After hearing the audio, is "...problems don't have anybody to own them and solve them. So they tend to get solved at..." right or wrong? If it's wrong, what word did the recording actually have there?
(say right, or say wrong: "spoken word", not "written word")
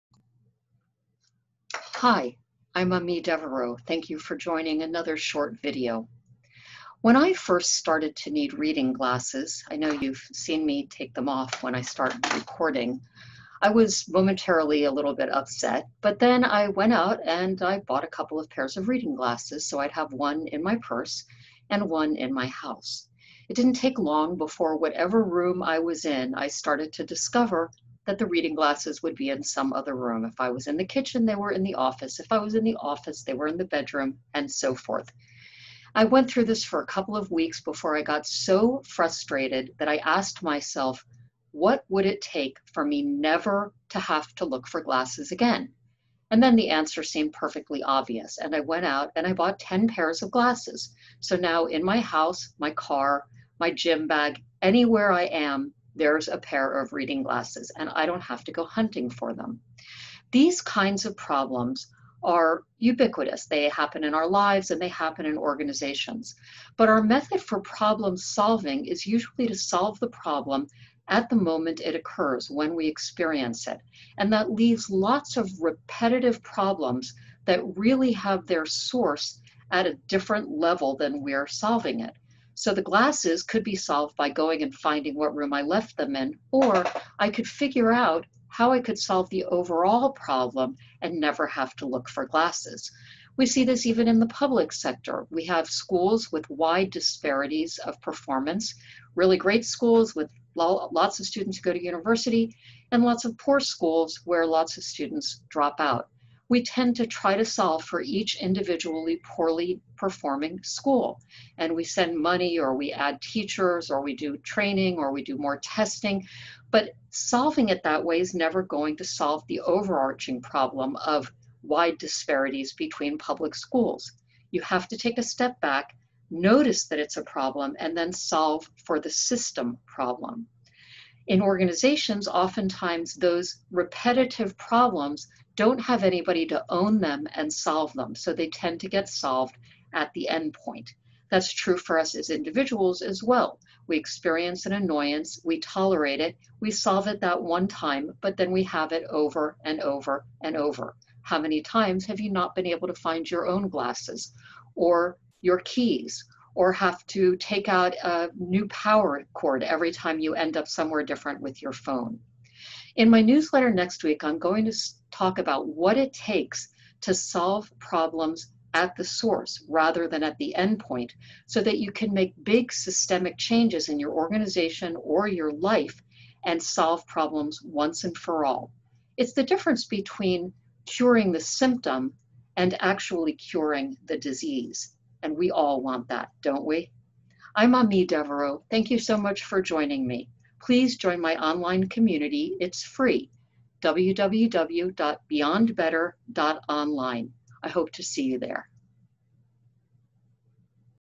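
right.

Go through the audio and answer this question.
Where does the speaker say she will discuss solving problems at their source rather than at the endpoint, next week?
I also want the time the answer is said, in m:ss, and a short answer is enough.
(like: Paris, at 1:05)
newsletter, at 2:43.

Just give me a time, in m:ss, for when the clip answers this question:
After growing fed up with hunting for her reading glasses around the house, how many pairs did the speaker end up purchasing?
0:49.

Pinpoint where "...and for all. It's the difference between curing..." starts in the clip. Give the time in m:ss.
2:58.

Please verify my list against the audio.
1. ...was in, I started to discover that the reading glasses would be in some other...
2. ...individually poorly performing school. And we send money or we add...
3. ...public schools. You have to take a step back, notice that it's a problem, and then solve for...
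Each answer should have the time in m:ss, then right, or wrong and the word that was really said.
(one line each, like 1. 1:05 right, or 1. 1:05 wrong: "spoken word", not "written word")
1. 0:25 right
2. 1:48 right
3. 2:03 right.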